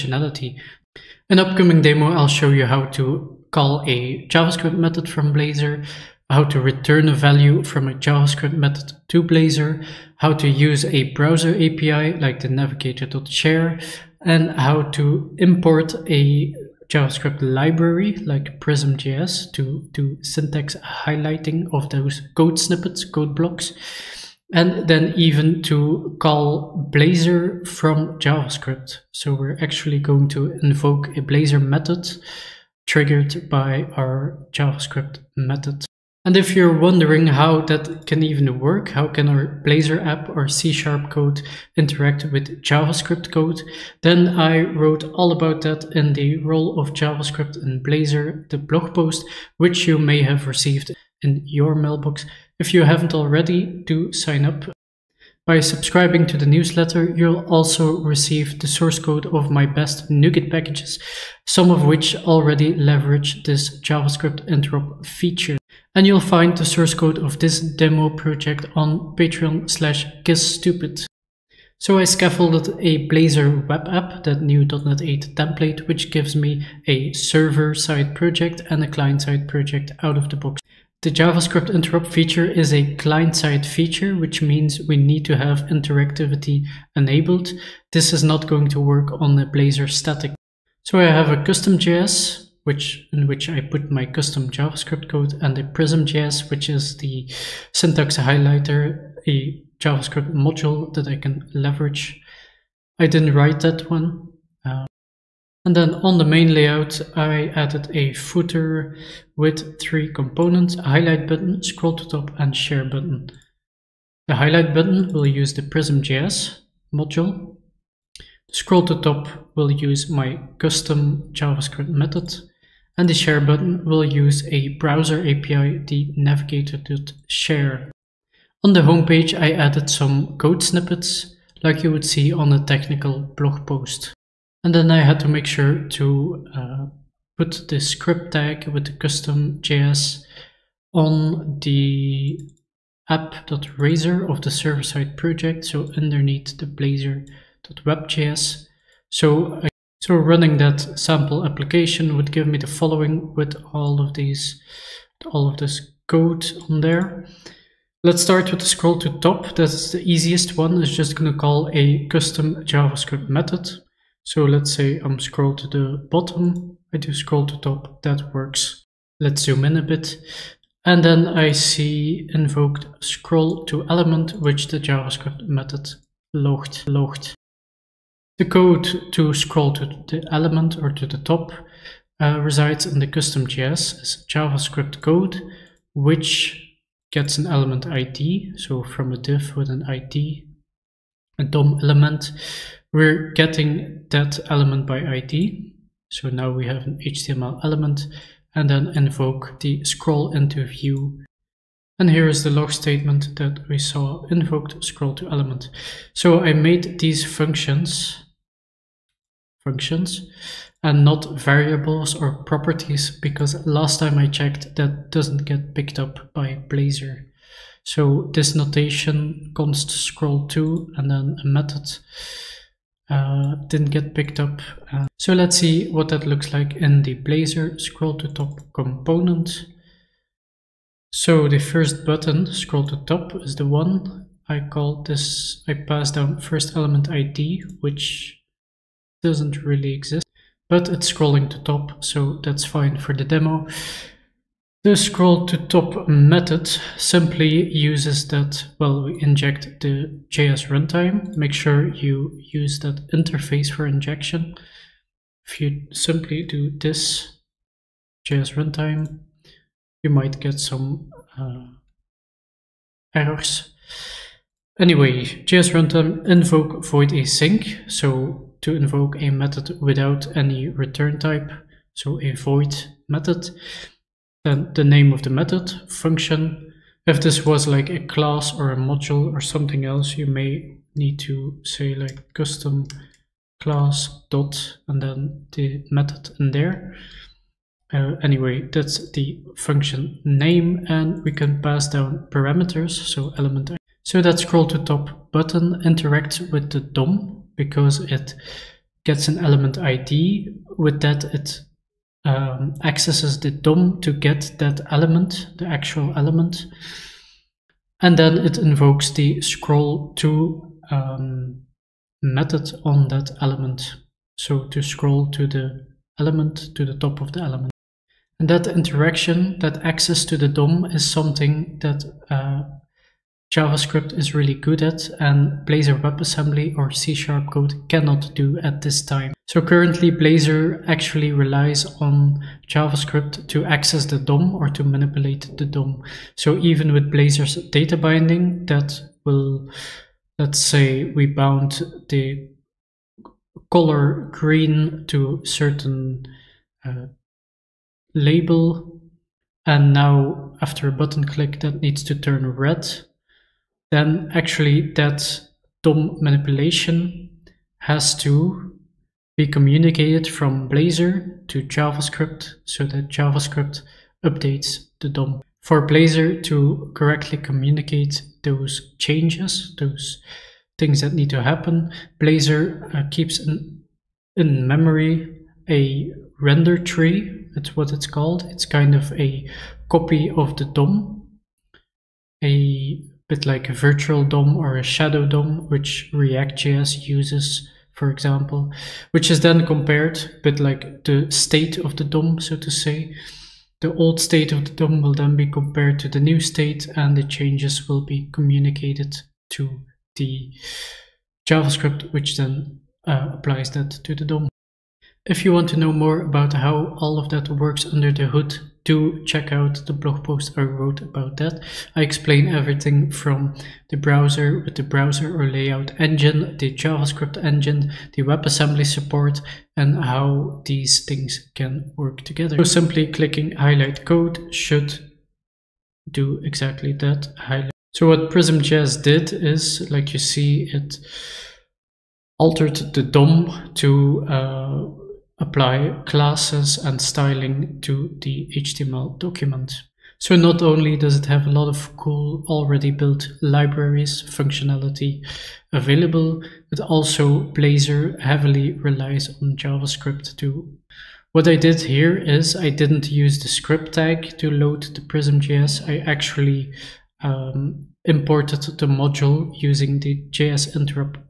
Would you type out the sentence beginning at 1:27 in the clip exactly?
This is not going to work on the Blazor static.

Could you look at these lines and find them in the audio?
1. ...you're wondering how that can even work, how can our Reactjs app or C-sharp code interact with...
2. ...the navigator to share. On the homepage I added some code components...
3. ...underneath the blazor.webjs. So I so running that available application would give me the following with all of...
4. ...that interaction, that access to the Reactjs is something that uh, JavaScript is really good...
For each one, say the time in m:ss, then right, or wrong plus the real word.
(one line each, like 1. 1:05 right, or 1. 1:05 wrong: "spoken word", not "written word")
1. 0:36 wrong: "Blazor", not "Reactjs"
2. 2:05 wrong: "snippets", not "components"
3. 2:25 wrong: "sample", not "available"
4. 5:18 wrong: "DOM", not "Reactjs".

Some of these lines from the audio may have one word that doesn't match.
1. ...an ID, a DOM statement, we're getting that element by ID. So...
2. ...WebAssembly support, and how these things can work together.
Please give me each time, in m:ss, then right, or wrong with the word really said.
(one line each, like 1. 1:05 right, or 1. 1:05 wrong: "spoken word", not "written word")
1. 3:09 wrong: "element", not "statement"
2. 6:58 right.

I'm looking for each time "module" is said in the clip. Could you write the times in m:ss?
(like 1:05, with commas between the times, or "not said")
1:40, 1:56, 4:38, 7:38.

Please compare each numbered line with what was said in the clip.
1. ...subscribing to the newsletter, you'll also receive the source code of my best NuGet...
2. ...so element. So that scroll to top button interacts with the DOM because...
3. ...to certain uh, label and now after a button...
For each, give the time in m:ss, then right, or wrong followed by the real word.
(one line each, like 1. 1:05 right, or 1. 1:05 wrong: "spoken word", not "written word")
1. 0:55 right
2. 4:52 right
3. 5:45 right.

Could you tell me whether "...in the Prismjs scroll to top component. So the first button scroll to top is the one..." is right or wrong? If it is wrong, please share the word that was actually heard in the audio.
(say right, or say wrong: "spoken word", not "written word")
wrong: "Blazor", not "Prismjs".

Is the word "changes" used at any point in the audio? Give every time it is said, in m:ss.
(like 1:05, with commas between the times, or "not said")
6:08, 6:37.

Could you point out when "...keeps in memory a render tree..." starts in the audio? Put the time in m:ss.
6:13.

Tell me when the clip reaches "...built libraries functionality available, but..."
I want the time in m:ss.
7:22.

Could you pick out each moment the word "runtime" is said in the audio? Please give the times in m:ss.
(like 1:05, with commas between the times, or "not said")
4:10, 4:18, 4:25.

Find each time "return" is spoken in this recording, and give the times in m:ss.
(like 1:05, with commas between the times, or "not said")
0:06, 4:30.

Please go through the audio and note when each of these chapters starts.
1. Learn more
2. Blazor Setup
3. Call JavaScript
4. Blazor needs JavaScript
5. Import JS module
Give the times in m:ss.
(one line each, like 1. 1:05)
1. 0:35
2. 1:34
3. 2:37
4. 5:18
5. 7:02.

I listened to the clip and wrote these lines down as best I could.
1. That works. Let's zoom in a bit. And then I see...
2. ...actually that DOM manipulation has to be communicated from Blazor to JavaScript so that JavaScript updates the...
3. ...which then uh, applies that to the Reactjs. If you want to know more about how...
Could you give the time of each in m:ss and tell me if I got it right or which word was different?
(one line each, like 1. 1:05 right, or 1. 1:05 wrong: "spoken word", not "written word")
1. 2:48 right
2. 5:54 right
3. 6:42 wrong: "DOM", not "Reactjs".